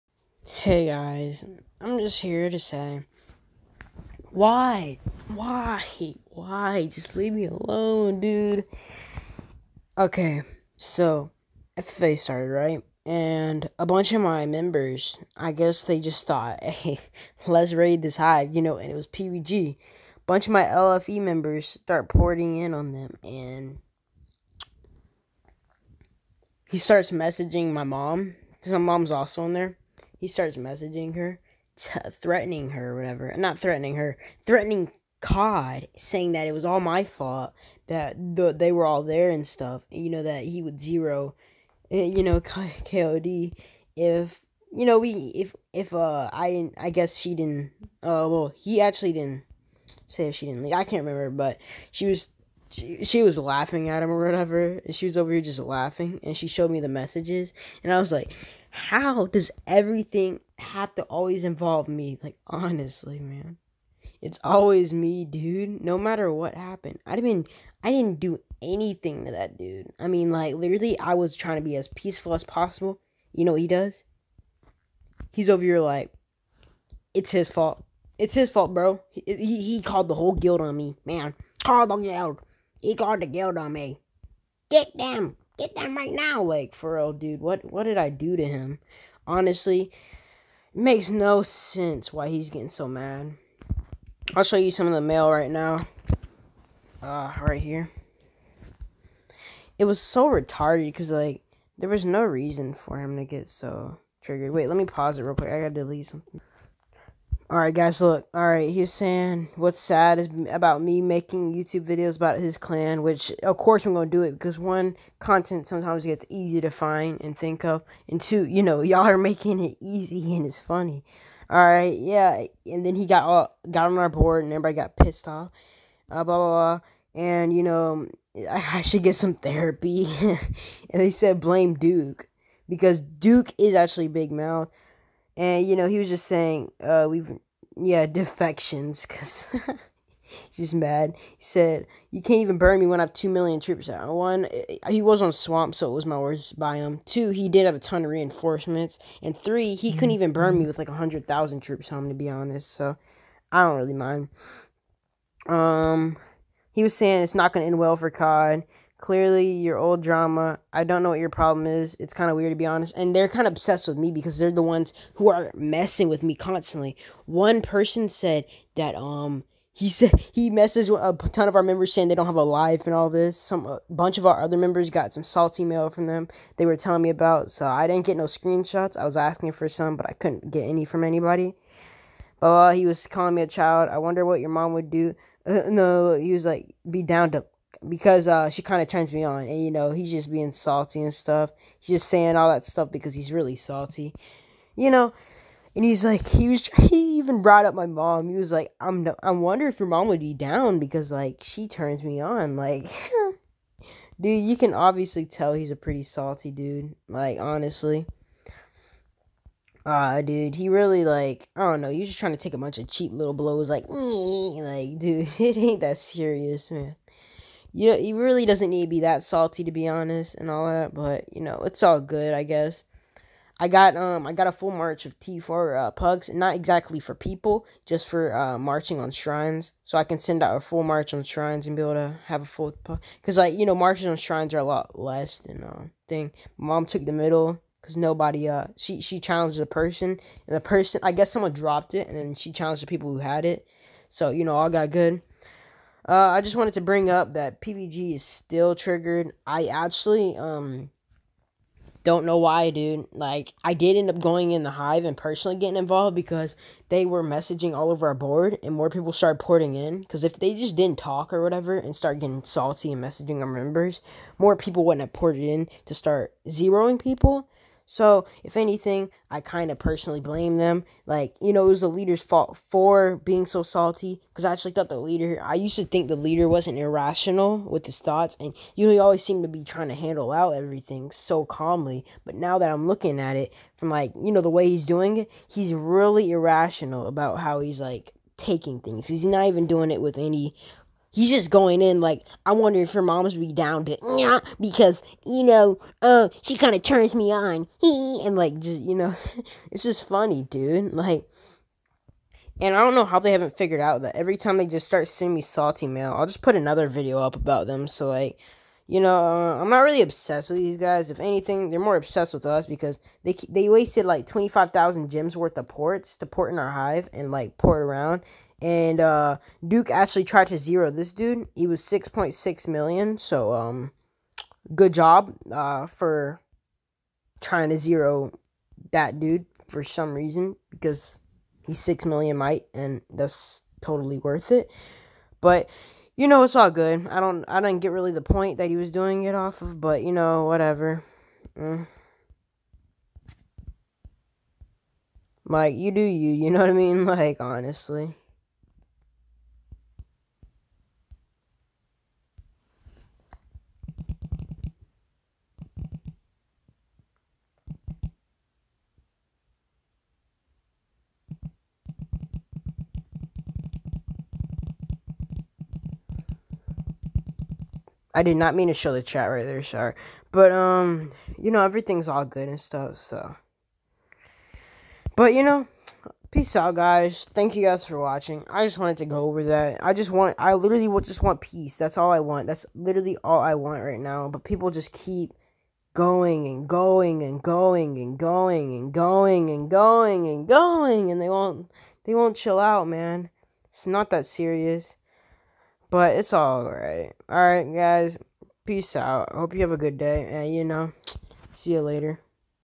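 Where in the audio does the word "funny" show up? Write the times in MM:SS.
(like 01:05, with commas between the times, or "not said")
02:00, 05:00.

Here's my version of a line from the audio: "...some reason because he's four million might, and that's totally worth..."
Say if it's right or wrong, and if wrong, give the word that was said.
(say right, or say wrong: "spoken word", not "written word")
wrong: "six", not "four".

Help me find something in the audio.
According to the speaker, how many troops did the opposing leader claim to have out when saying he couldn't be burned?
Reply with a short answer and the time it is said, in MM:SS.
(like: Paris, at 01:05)
2 million, at 02:23.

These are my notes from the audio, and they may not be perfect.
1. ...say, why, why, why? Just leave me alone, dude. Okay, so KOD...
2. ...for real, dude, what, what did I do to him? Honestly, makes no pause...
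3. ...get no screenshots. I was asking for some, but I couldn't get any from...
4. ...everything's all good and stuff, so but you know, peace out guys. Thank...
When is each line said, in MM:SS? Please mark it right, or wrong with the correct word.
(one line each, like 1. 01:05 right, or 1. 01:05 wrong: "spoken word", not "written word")
1. 00:02 wrong: "FFA", not "KOD"
2. 01:26 wrong: "sense", not "pause"
3. 02:58 right
4. 06:11 right.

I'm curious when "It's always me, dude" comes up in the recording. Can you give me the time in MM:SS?
01:04.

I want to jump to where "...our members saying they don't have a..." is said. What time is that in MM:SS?
02:51.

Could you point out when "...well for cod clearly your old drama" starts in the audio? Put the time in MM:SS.
02:37.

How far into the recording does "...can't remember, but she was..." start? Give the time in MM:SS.
00:50.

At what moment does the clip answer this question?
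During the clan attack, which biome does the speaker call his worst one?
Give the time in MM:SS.
02:25.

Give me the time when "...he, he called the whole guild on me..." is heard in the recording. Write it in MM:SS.
01:19.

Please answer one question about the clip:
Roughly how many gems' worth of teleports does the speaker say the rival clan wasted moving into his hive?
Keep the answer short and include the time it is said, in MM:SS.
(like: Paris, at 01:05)
25,000, at 05:14.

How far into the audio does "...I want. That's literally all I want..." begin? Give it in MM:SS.
06:22.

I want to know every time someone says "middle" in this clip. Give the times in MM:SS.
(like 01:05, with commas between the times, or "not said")
03:57.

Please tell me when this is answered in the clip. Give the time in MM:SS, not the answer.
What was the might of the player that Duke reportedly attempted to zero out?
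05:21.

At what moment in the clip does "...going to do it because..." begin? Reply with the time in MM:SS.
01:53.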